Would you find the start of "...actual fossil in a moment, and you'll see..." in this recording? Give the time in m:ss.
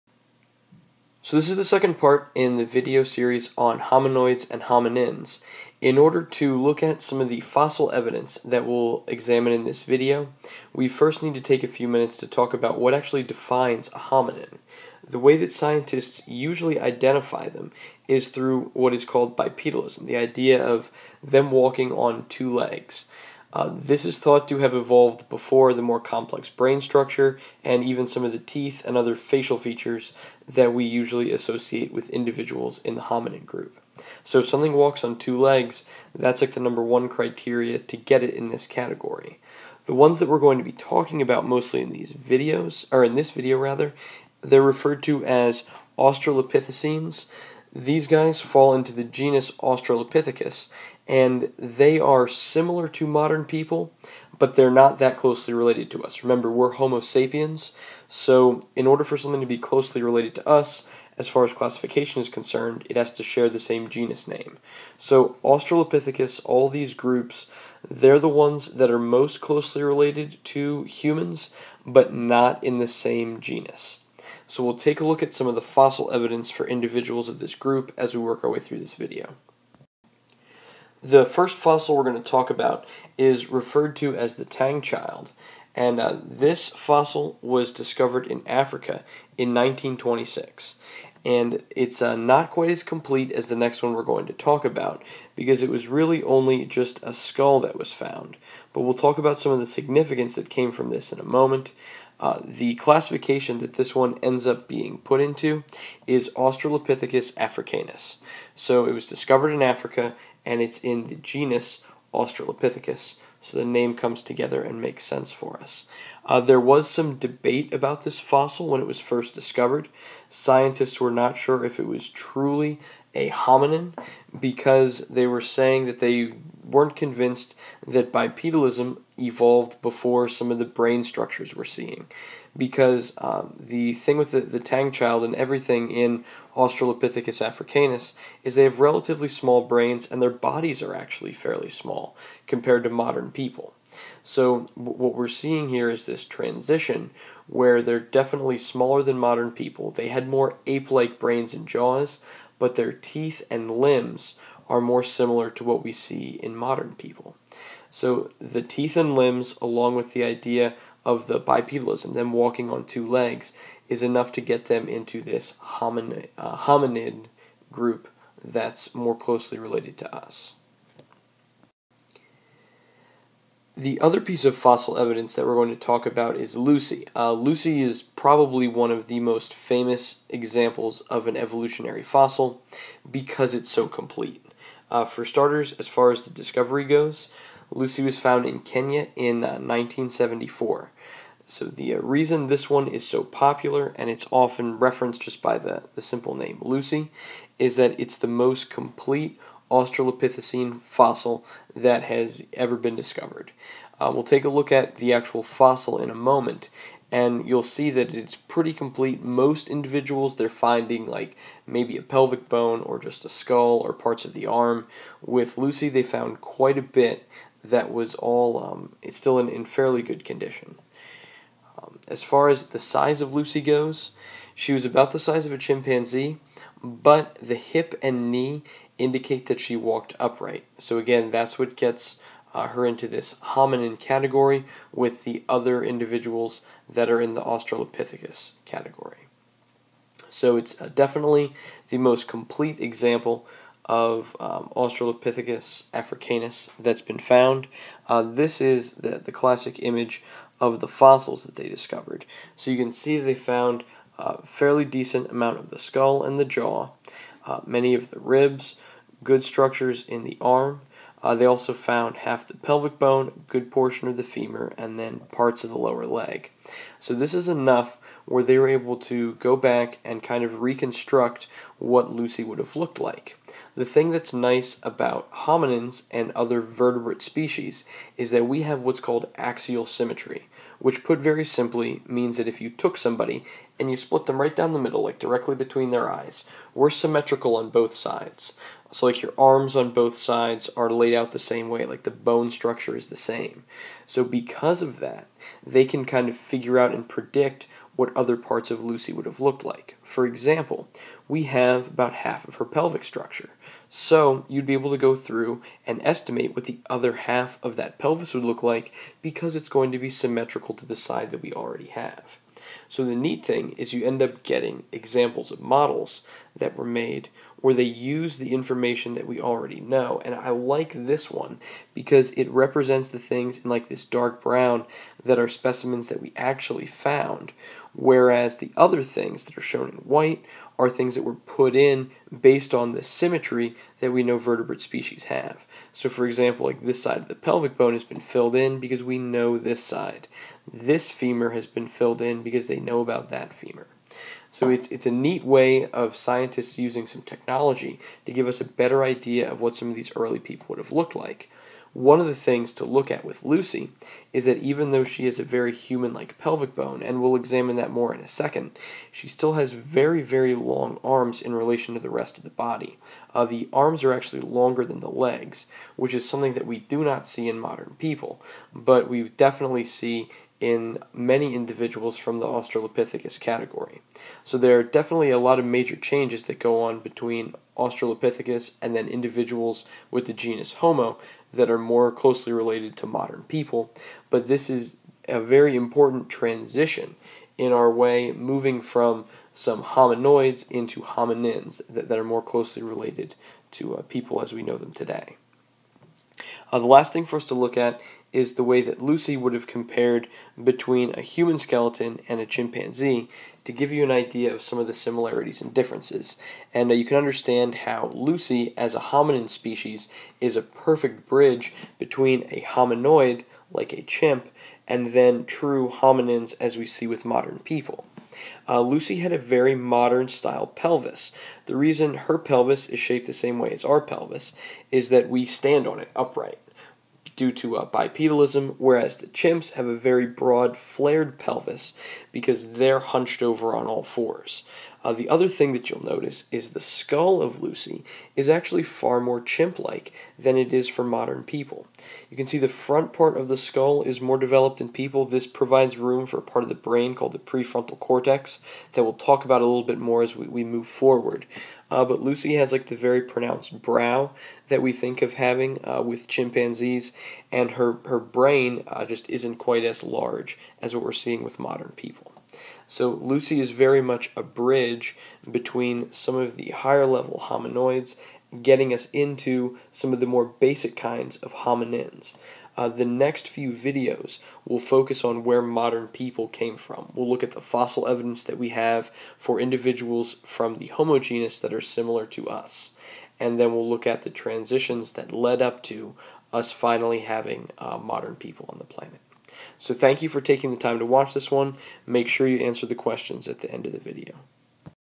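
3:25.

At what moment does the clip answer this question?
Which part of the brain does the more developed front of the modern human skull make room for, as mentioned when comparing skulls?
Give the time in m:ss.
7:27.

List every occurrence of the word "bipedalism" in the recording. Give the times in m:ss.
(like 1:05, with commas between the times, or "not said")
0:19, 2:08, 2:41, 7:07.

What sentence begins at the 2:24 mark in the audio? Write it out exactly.
So, what we're seeing here is this transition where they're definitely smaller than modern people.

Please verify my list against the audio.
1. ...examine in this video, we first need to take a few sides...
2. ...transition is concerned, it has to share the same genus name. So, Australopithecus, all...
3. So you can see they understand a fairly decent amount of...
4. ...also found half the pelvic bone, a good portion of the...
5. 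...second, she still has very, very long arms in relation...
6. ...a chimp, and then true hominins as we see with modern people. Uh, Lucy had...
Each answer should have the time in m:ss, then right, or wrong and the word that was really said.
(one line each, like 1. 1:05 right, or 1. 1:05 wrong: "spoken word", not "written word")
1. 0:09 wrong: "minutes", not "sides"
2. 1:01 wrong: "classification", not "transition"
3. 4:12 wrong: "found", not "understand"
4. 4:21 right
5. 5:58 right
6. 6:53 right.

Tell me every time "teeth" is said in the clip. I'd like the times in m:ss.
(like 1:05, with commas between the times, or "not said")
0:28, 2:32, 2:38.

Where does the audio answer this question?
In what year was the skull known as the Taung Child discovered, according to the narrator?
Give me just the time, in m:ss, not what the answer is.
1:29.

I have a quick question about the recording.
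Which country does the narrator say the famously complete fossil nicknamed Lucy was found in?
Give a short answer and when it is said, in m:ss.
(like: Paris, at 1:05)
Kenya, at 3:08.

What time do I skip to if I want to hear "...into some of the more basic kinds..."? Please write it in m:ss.
7:49.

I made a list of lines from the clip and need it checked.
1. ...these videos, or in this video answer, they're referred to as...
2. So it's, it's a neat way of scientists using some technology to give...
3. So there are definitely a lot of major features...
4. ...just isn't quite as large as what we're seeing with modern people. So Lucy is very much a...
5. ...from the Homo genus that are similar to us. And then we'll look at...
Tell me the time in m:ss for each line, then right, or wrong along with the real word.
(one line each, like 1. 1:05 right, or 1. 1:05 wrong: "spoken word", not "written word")
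1. 0:41 wrong: "rather", not "answer"
2. 5:44 right
3. 6:14 wrong: "changes", not "features"
4. 7:39 right
5. 8:00 right.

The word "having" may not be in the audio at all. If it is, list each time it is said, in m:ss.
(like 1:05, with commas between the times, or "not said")
7:35, 8:07.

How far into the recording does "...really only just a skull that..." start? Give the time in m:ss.
1:35.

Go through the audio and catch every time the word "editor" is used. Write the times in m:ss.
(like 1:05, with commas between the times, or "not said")
not said.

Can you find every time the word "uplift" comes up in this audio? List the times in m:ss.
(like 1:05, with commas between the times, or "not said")
not said.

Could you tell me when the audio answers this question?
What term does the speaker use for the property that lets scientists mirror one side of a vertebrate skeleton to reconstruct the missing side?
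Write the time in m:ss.
4:39.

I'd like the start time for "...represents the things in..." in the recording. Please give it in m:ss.
5:22.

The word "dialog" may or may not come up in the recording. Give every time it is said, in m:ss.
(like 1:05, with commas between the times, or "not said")
not said.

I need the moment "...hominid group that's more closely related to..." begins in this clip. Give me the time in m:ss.
2:46.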